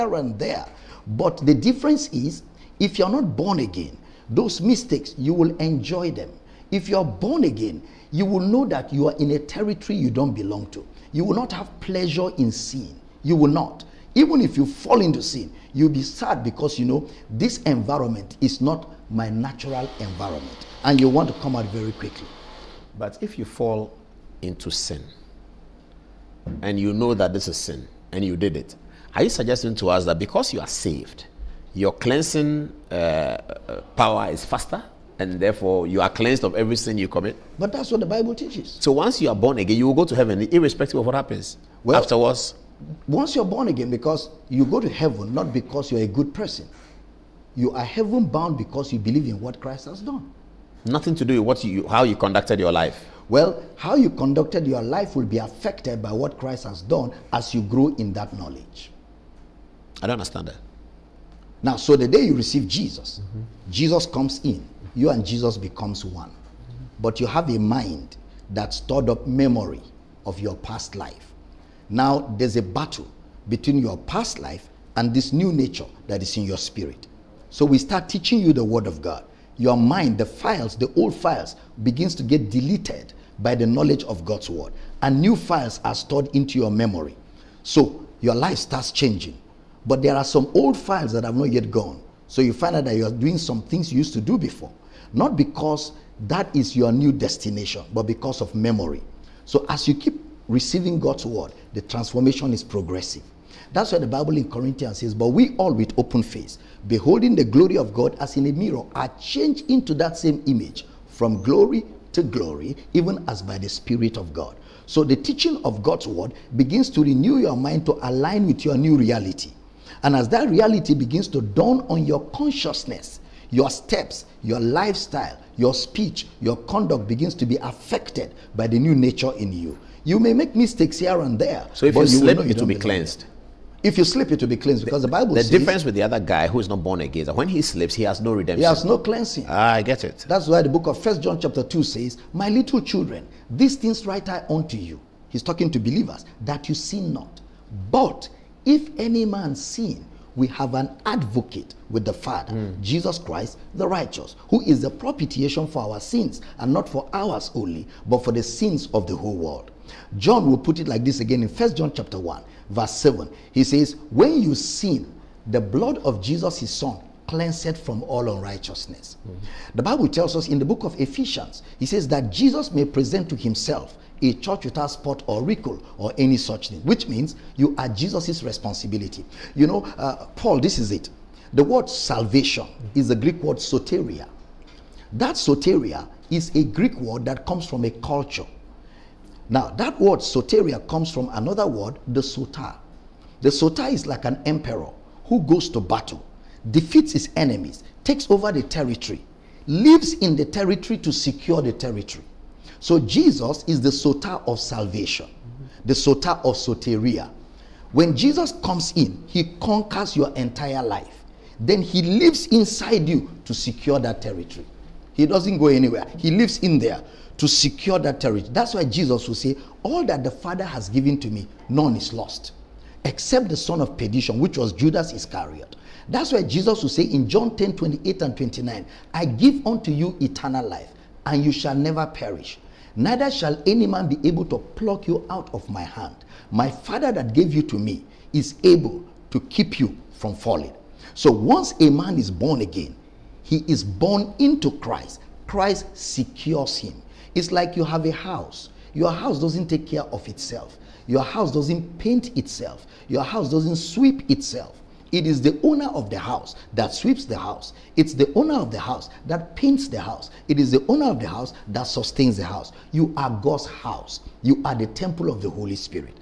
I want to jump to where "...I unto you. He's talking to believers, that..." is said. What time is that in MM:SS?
02:24.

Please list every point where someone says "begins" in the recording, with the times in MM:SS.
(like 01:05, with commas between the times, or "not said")
01:21, 01:56, 02:00, 02:07.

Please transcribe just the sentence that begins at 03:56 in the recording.
My Father that gave you to me is able to keep you from falling.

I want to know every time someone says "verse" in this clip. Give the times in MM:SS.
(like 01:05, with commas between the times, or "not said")
02:42.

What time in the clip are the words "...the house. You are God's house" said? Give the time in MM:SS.
04:22.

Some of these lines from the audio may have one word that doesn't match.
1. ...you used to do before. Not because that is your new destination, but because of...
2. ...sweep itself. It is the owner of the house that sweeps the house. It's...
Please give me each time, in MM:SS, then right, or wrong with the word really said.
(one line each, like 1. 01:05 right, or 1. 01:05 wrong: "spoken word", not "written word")
1. 01:33 right
2. 04:13 right.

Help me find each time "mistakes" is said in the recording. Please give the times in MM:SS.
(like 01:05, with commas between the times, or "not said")
00:04, 02:10.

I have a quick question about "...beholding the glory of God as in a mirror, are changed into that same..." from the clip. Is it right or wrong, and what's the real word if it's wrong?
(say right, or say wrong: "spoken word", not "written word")
right.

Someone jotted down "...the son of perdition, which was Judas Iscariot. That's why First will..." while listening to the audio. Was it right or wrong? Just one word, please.
wrong.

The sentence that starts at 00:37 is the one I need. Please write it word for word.
But that's what the Bible teaches.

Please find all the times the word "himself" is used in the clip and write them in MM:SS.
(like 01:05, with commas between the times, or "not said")
02:53.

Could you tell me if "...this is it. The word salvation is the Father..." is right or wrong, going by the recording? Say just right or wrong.
wrong.